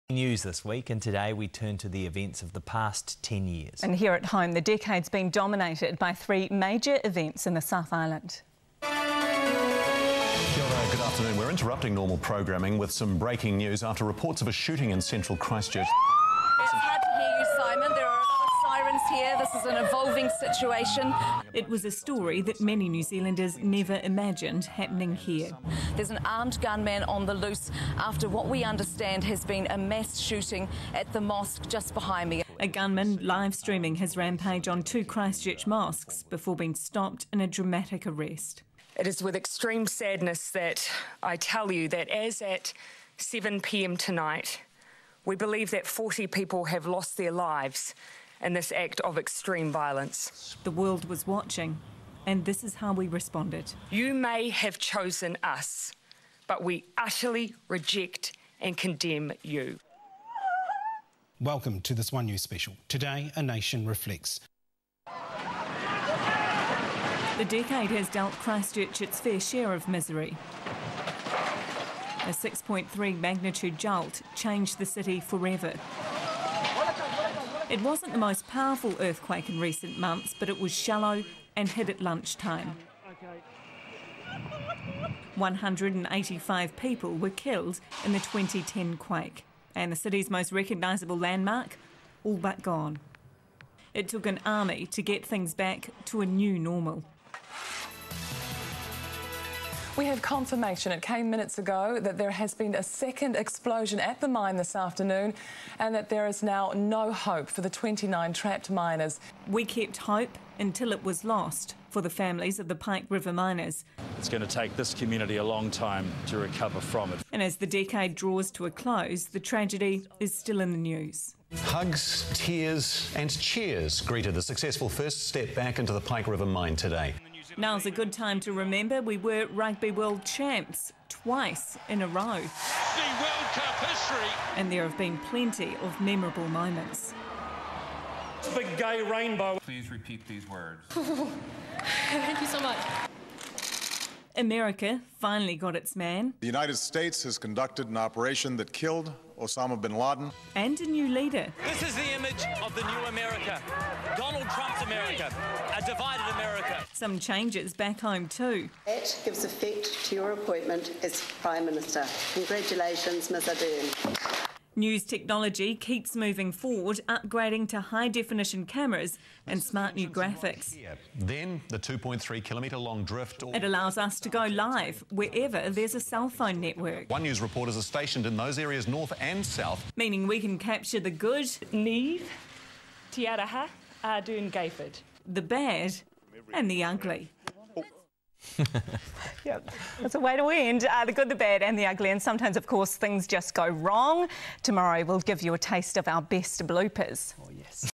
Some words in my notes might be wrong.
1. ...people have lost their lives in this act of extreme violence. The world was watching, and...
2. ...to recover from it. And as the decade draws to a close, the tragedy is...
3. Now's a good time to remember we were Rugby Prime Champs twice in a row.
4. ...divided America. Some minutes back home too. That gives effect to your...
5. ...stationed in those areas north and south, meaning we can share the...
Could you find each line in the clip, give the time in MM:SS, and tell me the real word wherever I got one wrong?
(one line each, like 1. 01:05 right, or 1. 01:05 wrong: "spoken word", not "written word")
1. 00:46 right
2. 01:56 right
3. 02:07 wrong: "World", not "Prime"
4. 02:35 wrong: "changes", not "minutes"
5. 02:57 wrong: "capture", not "share".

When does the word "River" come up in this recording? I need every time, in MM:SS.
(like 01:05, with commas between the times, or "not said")
01:53, 02:06.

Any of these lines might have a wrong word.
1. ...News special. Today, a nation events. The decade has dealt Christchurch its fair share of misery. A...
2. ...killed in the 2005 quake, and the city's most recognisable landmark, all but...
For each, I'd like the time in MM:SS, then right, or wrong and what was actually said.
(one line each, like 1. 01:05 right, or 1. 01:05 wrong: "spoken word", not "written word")
1. 01:02 wrong: "reflects", not "events"
2. 01:27 wrong: "2010", not "2005".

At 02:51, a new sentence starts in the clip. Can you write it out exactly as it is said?
Then the 2.3 kilometre long drift.